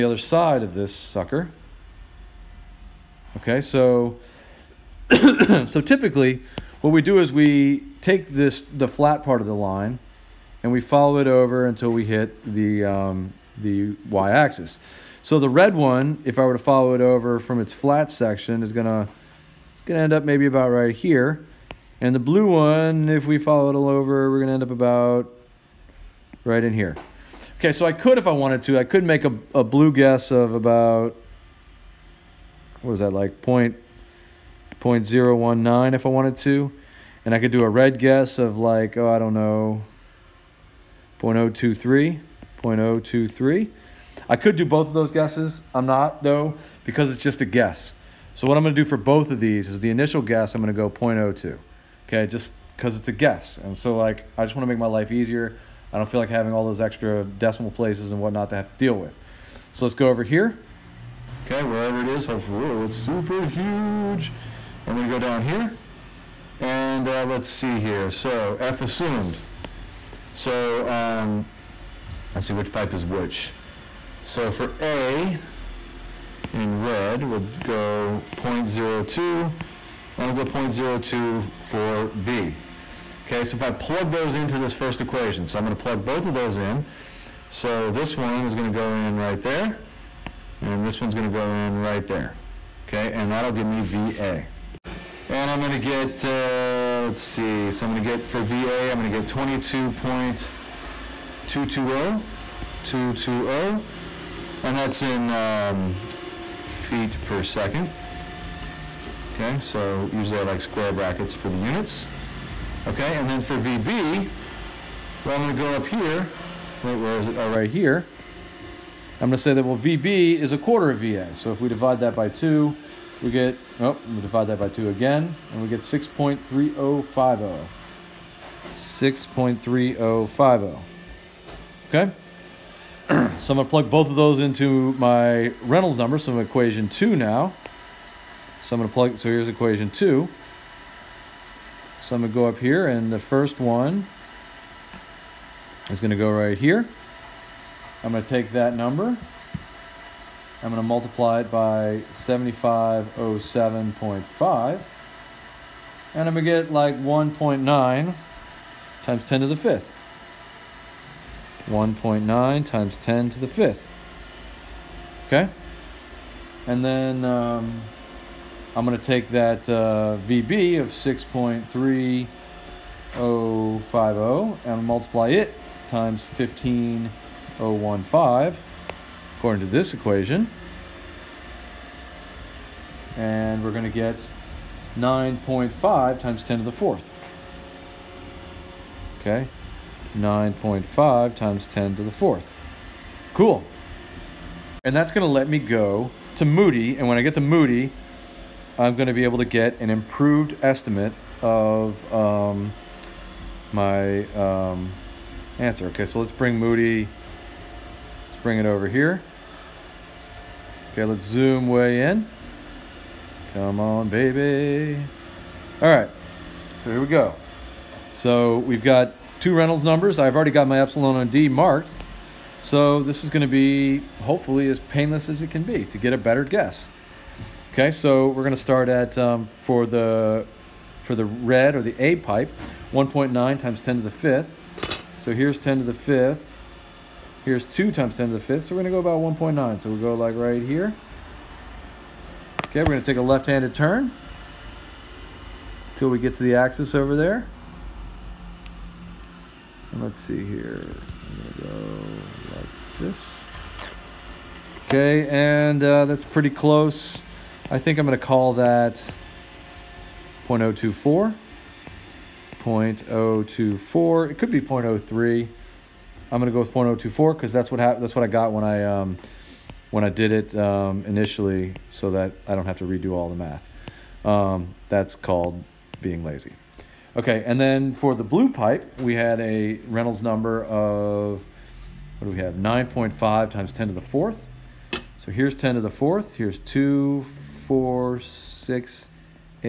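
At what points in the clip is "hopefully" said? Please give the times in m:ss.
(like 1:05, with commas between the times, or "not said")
1:02, 3:44.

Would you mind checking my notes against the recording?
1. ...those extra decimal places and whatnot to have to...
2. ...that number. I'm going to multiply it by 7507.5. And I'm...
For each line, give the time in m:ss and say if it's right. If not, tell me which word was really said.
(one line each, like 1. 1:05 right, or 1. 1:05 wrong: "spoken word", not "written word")
1. 0:56 right
2. 2:28 right.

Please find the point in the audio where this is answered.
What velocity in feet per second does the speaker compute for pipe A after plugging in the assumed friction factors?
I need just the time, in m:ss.
1:39.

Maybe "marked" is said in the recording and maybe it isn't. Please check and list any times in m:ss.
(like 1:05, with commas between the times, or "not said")
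3:41.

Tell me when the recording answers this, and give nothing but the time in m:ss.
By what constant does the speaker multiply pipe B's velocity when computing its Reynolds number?
2:56.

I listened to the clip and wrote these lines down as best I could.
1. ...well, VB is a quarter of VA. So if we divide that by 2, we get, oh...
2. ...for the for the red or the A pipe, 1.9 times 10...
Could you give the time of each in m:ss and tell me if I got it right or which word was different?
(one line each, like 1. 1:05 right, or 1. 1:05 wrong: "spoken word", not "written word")
1. 1:59 right
2. 3:49 right.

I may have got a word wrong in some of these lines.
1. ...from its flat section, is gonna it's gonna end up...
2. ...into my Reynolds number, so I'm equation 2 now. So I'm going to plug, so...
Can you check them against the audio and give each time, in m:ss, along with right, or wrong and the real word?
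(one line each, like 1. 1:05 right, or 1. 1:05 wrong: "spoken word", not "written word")
1. 0:17 right
2. 2:14 right.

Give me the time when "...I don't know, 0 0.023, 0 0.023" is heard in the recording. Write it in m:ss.
0:39.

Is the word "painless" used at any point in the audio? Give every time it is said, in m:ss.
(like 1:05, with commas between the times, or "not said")
3:44.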